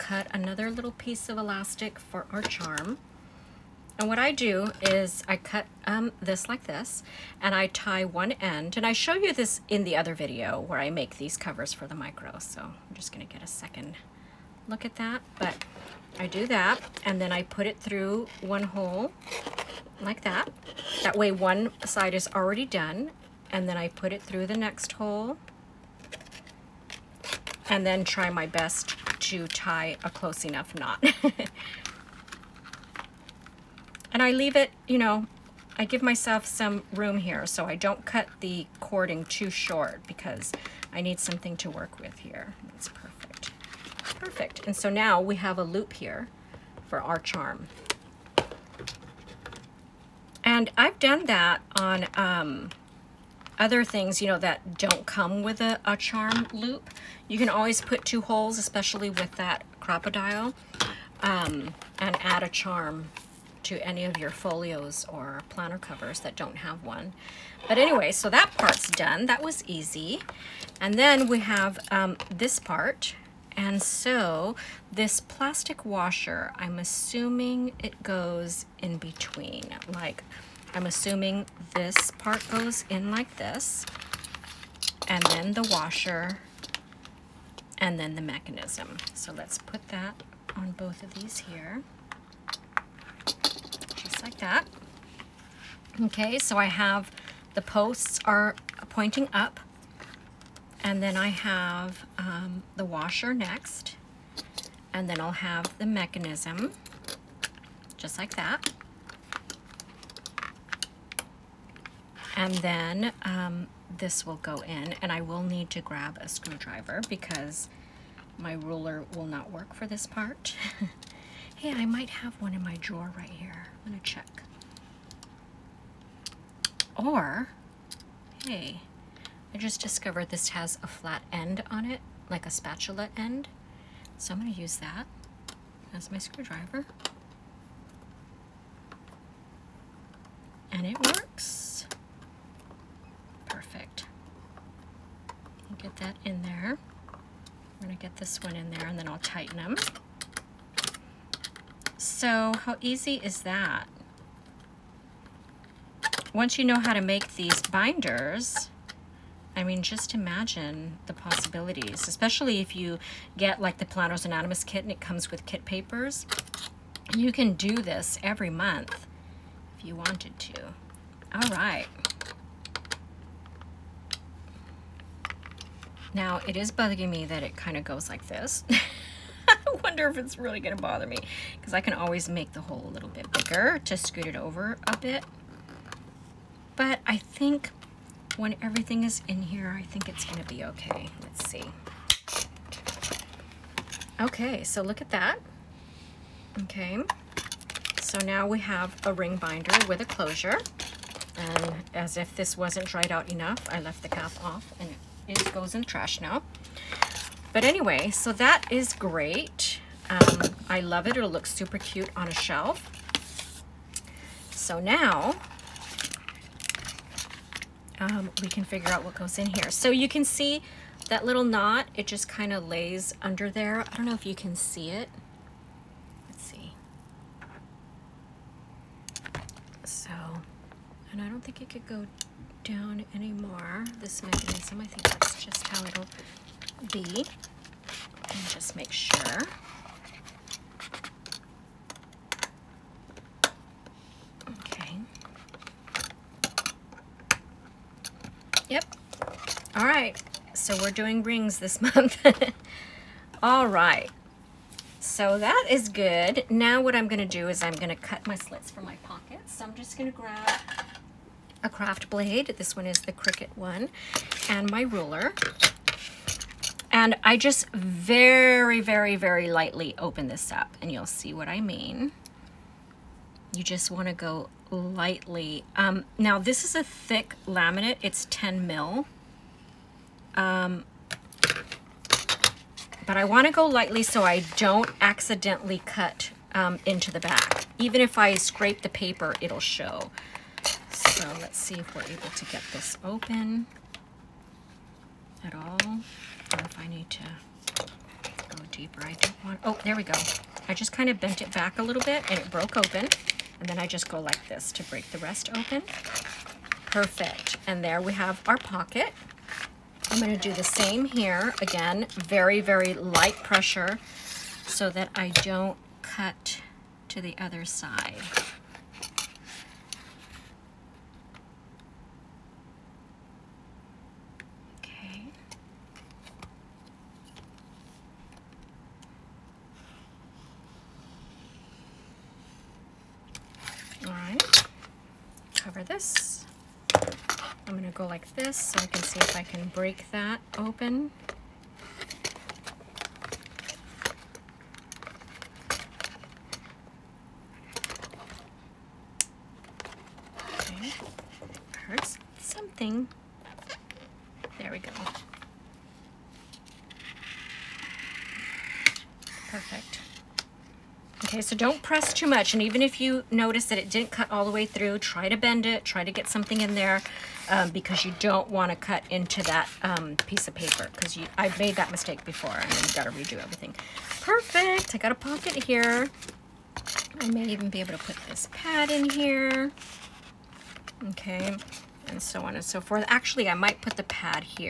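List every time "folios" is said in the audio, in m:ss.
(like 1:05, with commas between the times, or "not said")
1:04.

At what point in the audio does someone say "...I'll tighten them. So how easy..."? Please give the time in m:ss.
2:29.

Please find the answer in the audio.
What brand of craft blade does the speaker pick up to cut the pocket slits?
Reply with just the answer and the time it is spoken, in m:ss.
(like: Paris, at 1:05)
Cricut, at 4:23.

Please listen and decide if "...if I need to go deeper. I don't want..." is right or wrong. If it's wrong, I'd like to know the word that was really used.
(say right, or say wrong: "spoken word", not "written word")
right.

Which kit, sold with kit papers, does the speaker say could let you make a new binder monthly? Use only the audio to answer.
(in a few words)
Planners Anonymous.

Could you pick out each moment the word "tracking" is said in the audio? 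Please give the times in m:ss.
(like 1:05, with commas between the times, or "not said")
not said.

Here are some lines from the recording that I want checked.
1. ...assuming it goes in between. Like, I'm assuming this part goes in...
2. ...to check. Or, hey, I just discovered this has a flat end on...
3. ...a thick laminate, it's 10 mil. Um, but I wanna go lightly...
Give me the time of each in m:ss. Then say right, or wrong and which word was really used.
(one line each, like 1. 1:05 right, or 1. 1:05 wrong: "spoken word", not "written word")
1. 1:16 right
2. 2:03 right
3. 4:36 right.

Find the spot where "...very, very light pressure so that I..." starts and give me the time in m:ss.
5:12.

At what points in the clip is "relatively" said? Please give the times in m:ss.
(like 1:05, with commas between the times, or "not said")
not said.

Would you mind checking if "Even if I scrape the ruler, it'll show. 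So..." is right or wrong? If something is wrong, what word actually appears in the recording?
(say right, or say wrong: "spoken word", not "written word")
wrong: "paper", not "ruler".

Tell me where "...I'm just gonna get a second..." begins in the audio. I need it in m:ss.
0:12.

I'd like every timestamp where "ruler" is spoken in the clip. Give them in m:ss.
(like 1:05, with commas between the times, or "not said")
1:58, 4:24.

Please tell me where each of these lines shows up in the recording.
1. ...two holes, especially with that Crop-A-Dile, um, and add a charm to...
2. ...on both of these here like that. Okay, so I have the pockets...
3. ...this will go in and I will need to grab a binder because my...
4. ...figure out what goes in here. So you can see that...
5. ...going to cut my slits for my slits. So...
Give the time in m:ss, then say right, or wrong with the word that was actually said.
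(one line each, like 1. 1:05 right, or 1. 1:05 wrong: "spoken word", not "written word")
1. 0:58 right
2. 1:30 wrong: "posts", not "pockets"
3. 1:53 wrong: "screwdriver", not "binder"
4. 3:38 right
5. 4:17 wrong: "pockets", not "slits".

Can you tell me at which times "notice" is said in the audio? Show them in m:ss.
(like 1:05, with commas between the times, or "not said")
6:03.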